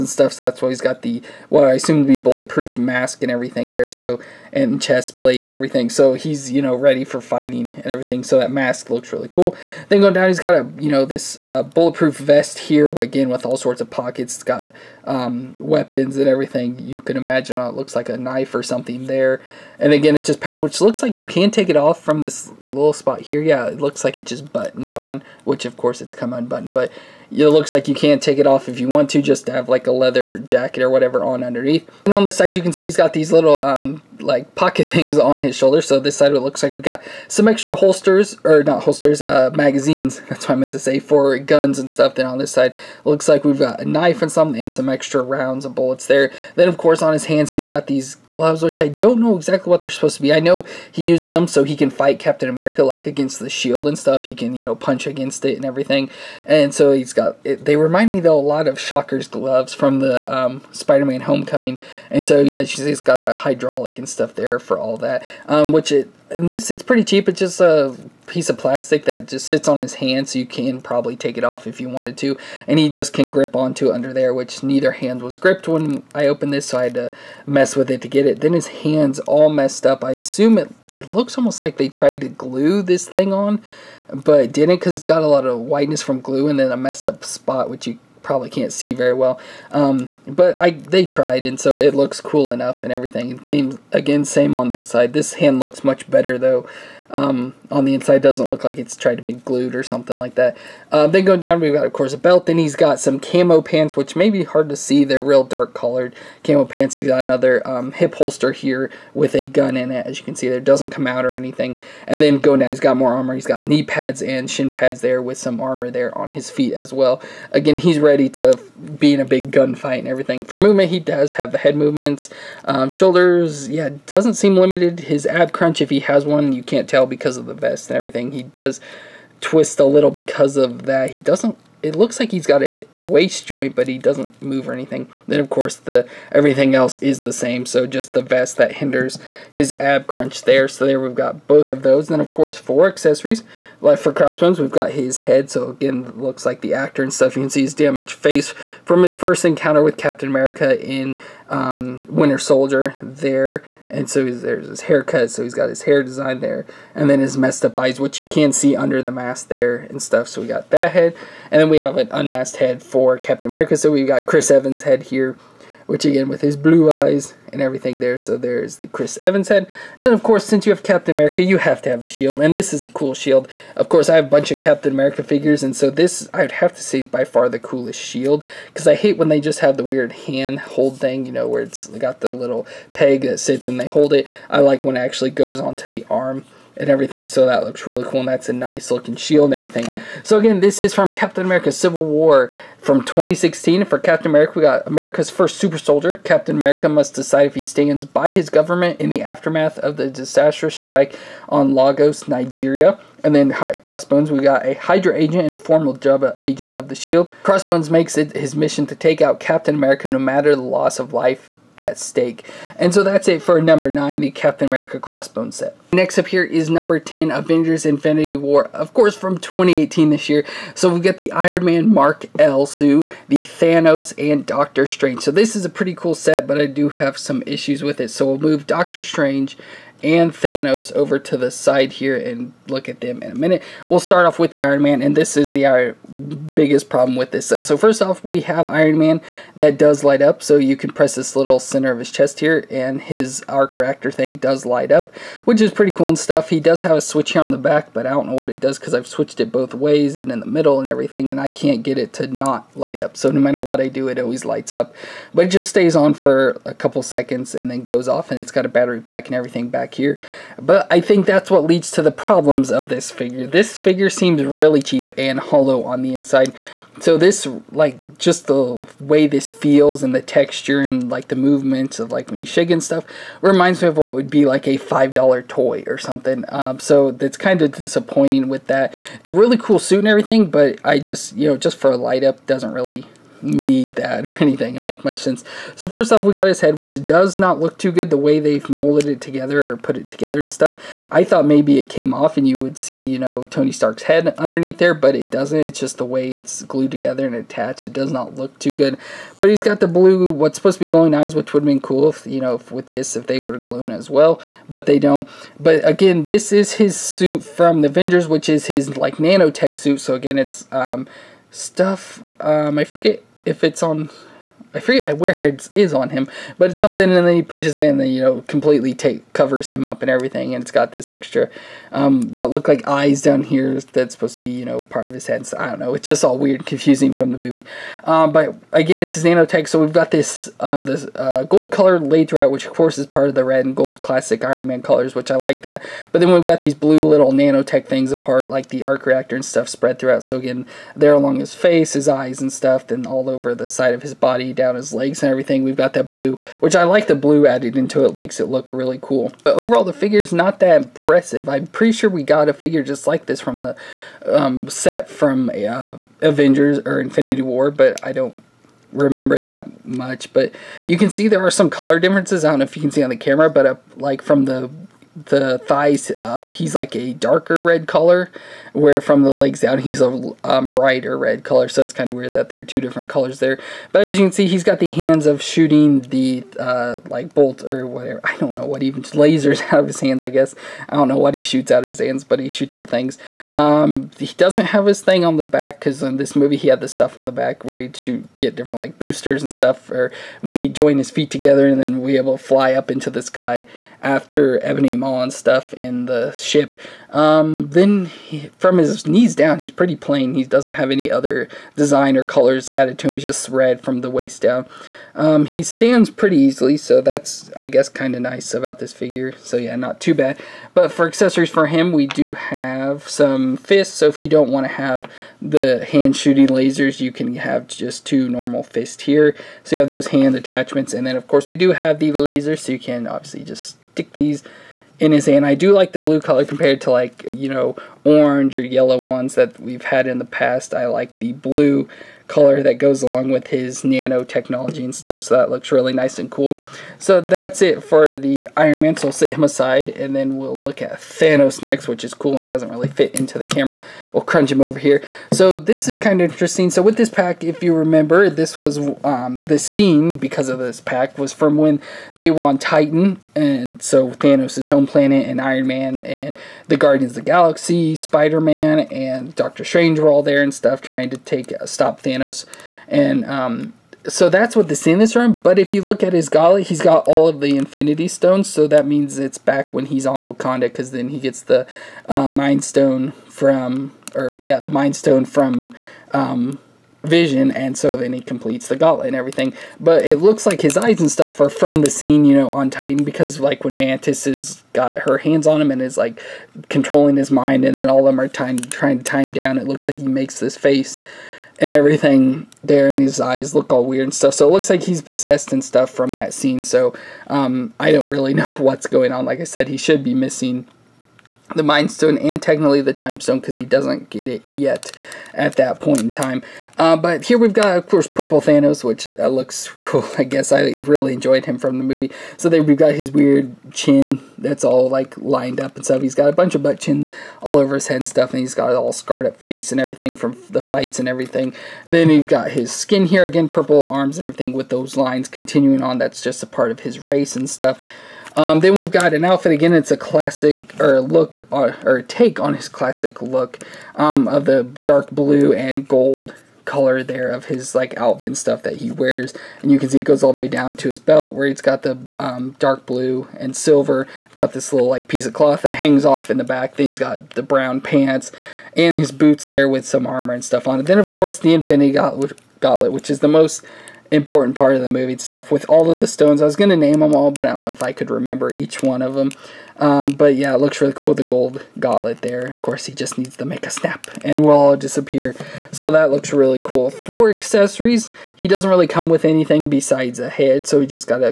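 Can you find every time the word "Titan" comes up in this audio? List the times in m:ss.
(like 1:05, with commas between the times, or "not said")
7:32, 8:02.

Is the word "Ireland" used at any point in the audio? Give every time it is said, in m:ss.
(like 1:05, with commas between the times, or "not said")
not said.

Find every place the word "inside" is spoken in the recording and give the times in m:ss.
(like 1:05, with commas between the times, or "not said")
1:37, 4:26.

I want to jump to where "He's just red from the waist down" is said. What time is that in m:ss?
6:43.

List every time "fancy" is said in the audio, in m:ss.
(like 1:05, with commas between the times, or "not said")
not said.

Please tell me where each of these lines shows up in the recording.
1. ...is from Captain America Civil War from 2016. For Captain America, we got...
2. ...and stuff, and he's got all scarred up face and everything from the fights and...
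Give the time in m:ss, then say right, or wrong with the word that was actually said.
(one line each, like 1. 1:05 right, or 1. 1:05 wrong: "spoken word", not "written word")
1. 3:10 right
2. 8:37 right.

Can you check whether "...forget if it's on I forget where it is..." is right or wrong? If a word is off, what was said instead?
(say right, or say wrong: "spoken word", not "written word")
right.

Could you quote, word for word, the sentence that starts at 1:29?
Um, but I they tried, and so it looks cool enough and everything.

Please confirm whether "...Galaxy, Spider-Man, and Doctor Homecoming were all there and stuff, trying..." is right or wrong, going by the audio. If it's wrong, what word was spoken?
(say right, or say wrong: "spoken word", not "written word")
wrong: "Strange", not "Homecoming".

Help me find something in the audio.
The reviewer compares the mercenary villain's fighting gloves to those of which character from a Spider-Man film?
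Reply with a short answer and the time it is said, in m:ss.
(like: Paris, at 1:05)
Shocker, at 0:58.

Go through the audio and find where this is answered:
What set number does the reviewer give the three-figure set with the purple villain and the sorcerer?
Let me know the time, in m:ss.
3:36.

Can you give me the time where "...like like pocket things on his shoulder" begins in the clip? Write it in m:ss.
0:34.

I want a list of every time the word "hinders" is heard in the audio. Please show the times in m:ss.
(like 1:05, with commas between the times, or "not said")
2:18.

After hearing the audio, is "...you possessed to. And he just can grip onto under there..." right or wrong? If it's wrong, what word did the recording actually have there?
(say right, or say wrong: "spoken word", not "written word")
wrong: "wanted", not "possessed".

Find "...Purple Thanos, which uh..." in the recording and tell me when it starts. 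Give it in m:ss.
8:28.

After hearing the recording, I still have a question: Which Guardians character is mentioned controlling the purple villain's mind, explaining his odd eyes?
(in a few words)
Mantis.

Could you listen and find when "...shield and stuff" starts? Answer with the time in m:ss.
0:53.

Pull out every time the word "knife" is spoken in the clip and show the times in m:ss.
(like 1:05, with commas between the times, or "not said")
0:18, 0:43.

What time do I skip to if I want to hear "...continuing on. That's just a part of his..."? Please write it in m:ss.
8:45.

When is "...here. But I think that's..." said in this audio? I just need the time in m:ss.
4:19.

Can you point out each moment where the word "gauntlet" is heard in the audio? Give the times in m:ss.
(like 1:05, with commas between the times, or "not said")
7:46, 7:58, 9:11, 9:21.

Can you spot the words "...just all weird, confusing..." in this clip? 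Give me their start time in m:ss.
5:26.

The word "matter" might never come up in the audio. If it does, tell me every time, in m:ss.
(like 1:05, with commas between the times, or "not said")
3:30, 4:13.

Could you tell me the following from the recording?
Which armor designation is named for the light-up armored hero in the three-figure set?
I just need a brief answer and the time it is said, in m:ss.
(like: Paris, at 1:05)
Mark L, at 3:41.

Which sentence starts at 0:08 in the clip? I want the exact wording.
So that mask looks really cool.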